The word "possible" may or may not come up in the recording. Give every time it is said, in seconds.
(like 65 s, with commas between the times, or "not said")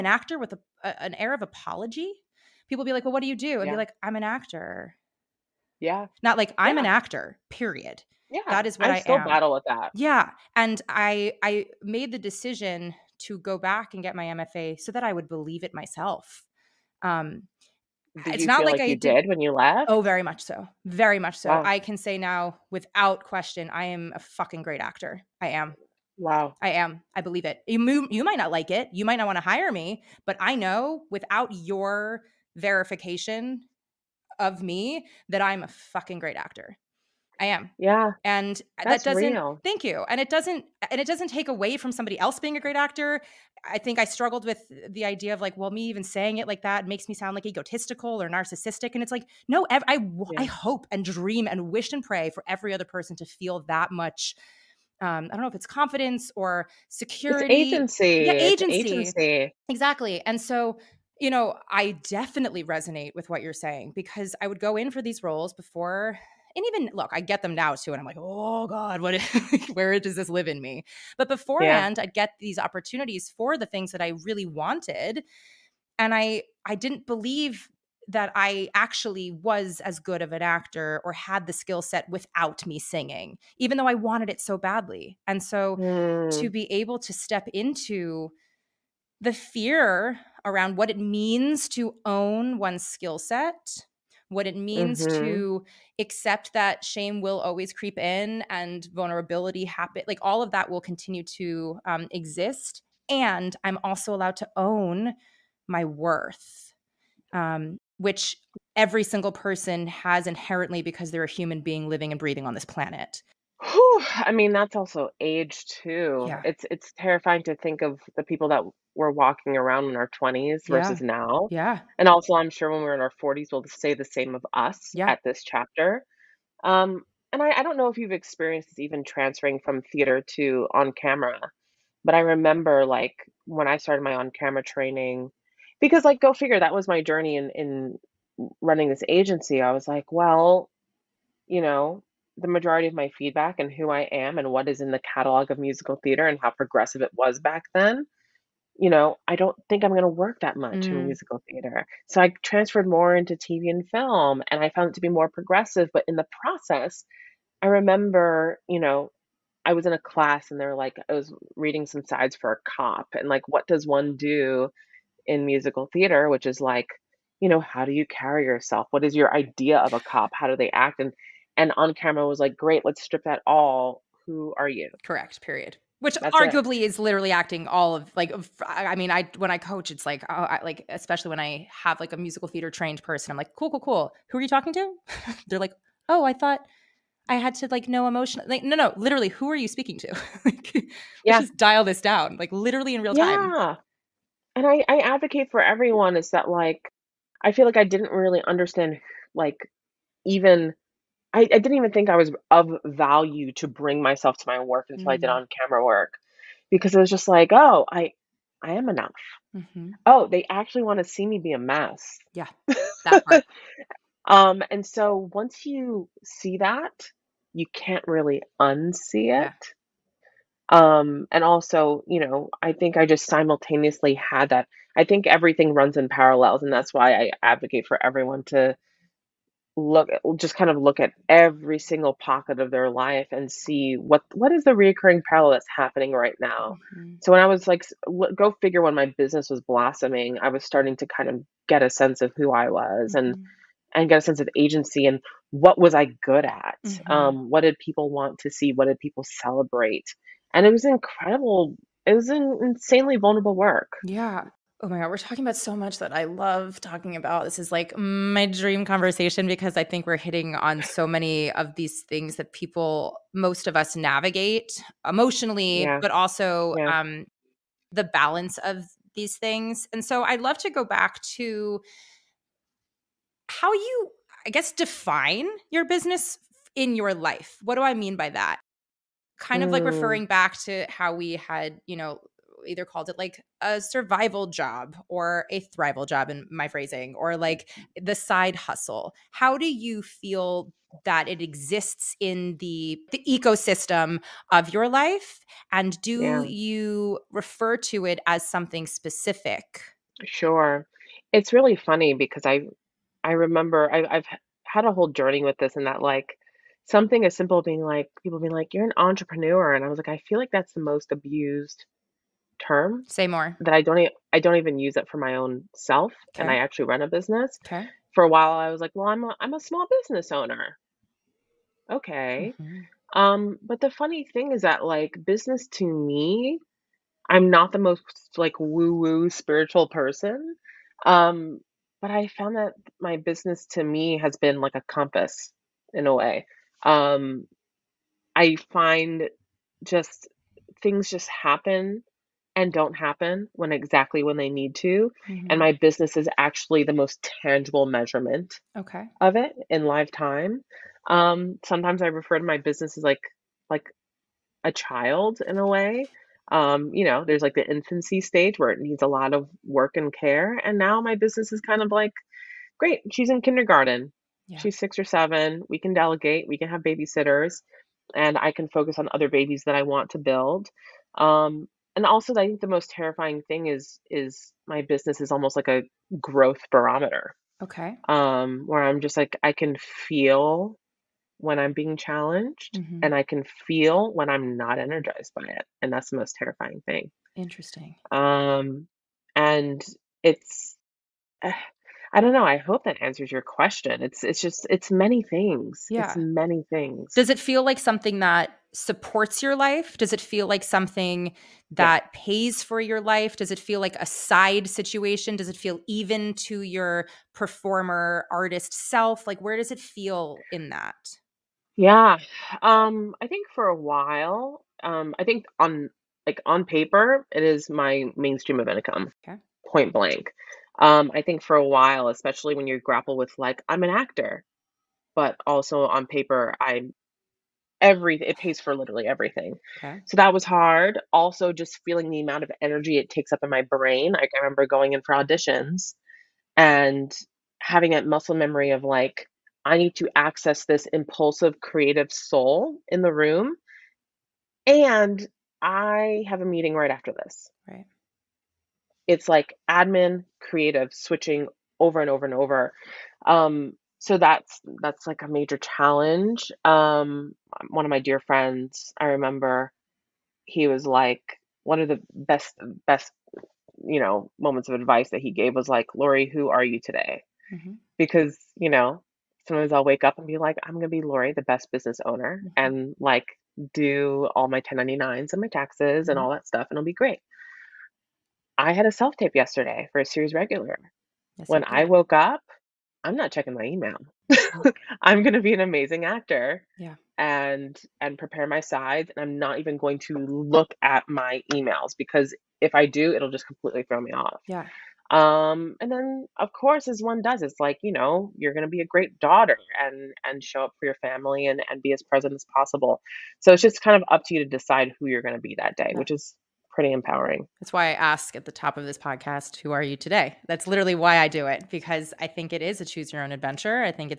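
502 s.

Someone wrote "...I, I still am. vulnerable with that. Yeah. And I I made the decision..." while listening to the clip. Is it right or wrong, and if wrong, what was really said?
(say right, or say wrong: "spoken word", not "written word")
wrong: "battle", not "vulnerable".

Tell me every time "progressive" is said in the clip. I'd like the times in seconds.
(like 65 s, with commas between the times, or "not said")
146 s, 155 s.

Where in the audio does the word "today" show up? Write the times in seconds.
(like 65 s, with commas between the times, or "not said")
466 s, 509 s.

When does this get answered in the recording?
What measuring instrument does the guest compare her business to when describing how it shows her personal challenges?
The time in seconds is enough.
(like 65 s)
376 s.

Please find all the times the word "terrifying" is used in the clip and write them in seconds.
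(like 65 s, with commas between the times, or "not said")
116 s, 372 s, 386 s.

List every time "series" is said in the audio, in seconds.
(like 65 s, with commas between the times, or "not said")
480 s.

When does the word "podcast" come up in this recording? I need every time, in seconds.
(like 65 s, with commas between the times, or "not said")
508 s.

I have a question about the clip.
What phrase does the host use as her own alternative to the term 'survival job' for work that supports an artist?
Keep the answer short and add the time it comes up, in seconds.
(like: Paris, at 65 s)
Thrival job, at 285 s.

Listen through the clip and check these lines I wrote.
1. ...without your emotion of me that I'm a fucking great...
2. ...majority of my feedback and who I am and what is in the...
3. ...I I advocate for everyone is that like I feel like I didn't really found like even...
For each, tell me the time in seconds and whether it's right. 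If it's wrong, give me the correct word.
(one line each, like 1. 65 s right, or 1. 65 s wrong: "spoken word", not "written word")
1. 31 s wrong: "verification", not "emotion"
2. 142 s right
3. 194 s wrong: "understand", not "found".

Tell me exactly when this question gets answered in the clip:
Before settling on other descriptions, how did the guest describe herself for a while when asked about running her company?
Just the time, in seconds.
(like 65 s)
319 s.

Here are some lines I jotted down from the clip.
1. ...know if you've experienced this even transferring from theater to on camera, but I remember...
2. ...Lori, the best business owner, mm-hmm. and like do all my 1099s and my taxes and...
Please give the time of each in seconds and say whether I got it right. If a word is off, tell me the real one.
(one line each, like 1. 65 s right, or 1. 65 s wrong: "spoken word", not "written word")
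1. 127 s right
2. 470 s right.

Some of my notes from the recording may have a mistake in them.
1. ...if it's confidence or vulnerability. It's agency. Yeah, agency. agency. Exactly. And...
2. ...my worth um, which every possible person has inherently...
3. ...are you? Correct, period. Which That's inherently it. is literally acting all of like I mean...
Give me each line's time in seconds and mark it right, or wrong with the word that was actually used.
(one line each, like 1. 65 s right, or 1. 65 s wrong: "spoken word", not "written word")
1. 55 s wrong: "security", not "vulnerability"
2. 105 s wrong: "single", not "possible"
3. 174 s wrong: "arguably", not "inherently".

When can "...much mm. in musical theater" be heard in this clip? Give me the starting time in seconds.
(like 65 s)
150 s.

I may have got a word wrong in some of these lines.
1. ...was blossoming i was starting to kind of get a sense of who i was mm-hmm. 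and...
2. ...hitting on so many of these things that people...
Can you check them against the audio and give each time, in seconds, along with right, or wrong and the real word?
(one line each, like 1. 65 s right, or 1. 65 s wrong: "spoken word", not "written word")
1. 239 s right
2. 260 s right.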